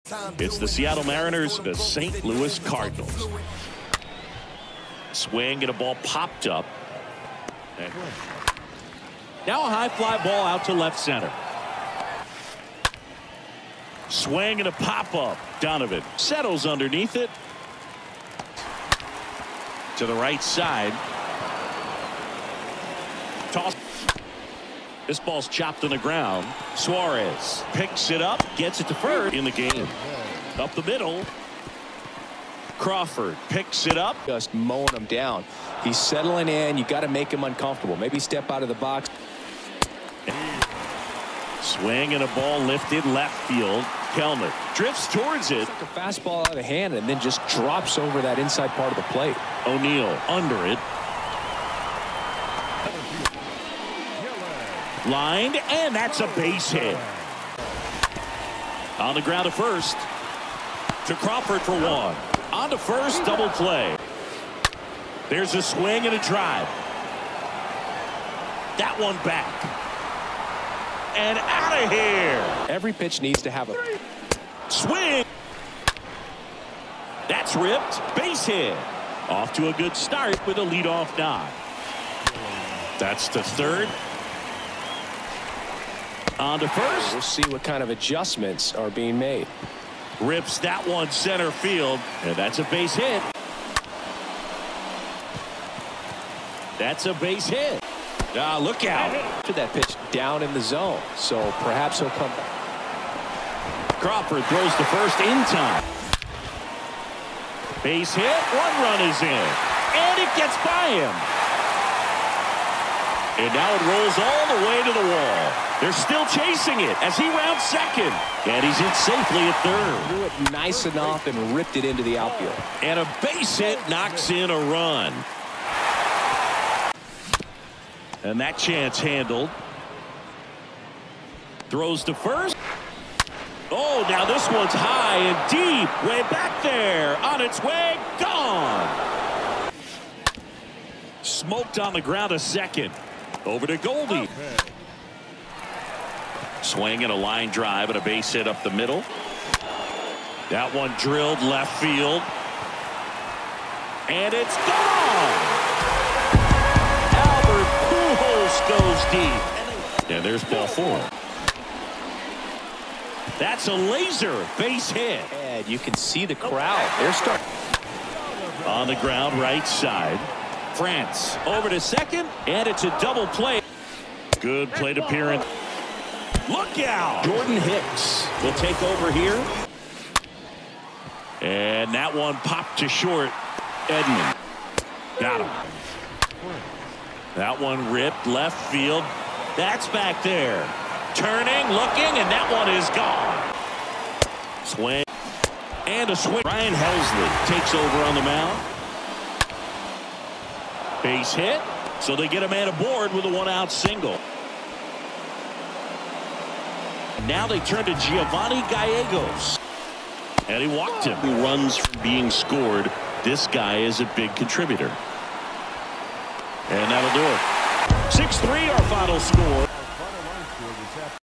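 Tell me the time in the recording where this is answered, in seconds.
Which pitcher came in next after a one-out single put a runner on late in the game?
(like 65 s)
207 s.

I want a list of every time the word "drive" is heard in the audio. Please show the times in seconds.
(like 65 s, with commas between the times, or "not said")
66 s, 147 s.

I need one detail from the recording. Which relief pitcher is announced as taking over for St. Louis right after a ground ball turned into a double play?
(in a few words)
Jordan Hicks.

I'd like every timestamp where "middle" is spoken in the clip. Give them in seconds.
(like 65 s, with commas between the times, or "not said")
30 s, 148 s.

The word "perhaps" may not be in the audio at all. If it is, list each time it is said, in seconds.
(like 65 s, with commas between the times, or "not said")
101 s.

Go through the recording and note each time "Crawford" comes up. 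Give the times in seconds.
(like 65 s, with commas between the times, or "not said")
32 s, 61 s, 104 s.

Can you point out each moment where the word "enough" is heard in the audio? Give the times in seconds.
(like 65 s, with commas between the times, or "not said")
120 s.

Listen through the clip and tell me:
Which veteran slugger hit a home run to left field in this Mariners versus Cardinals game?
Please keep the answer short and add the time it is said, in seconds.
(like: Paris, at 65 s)
Albert Pujols, at 157 s.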